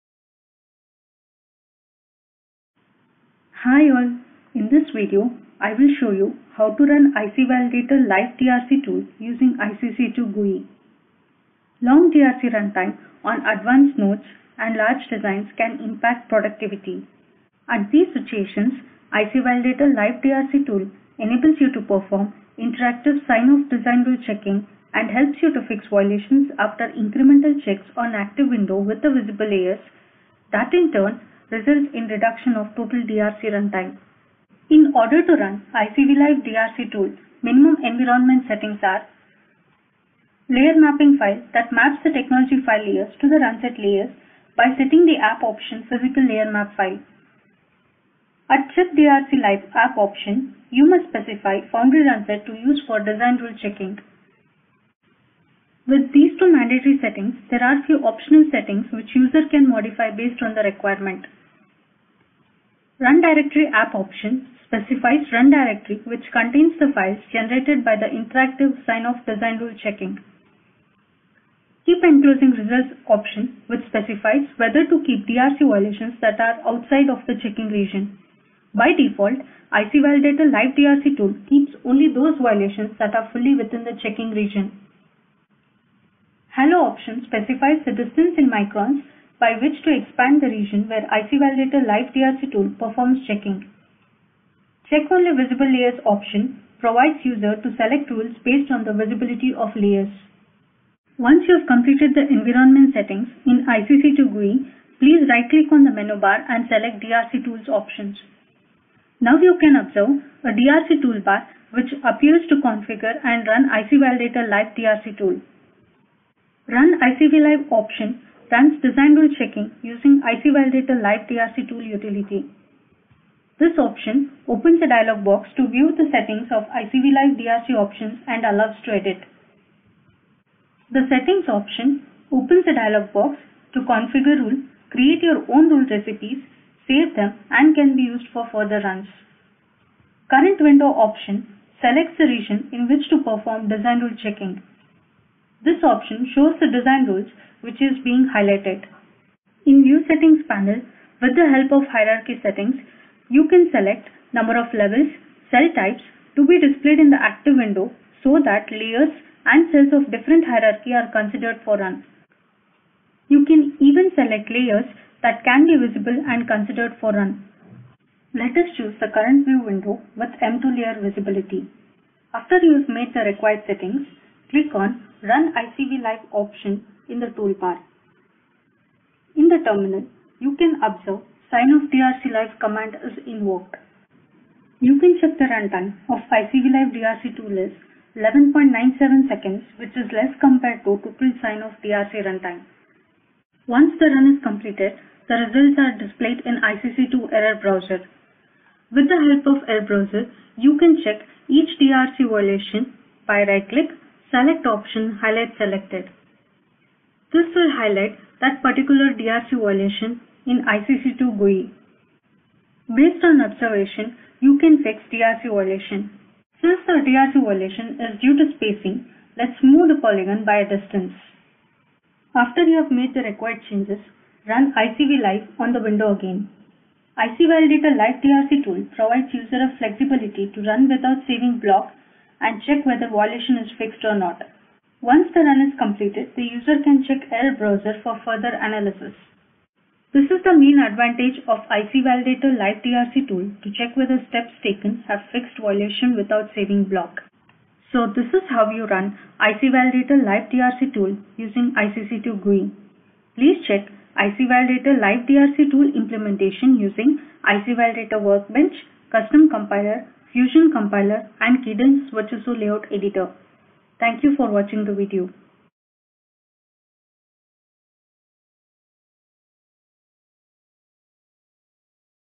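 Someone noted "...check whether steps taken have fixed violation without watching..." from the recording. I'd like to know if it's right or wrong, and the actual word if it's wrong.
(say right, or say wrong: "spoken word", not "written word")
wrong: "saving", not "watching".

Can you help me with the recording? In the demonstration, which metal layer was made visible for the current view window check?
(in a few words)
M2.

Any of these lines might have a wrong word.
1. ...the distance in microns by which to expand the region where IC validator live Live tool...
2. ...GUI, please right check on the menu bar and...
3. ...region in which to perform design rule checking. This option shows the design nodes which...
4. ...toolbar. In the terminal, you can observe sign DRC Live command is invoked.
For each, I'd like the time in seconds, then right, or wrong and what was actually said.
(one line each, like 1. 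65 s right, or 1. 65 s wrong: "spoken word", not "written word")
1. 87 s wrong: "DRC", not "Live"
2. 104 s wrong: "click", not "check"
3. 142 s wrong: "rules", not "nodes"
4. 177 s right.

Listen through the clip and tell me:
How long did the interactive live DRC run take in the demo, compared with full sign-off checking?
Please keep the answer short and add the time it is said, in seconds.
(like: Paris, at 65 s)
11.97 seconds, at 188 s.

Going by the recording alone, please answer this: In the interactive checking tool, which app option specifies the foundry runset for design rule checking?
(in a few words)
chip DRC live.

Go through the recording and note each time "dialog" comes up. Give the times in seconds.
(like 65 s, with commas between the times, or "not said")
124 s, 132 s.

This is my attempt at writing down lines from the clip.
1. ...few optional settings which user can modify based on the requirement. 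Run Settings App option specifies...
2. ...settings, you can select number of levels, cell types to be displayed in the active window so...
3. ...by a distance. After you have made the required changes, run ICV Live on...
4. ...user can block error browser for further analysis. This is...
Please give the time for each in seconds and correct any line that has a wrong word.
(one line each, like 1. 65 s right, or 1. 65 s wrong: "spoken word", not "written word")
1. 57 s wrong: "Directory", not "Settings"
2. 152 s right
3. 220 s right
4. 236 s wrong: "check", not "block".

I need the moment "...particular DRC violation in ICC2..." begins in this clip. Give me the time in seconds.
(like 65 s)
208 s.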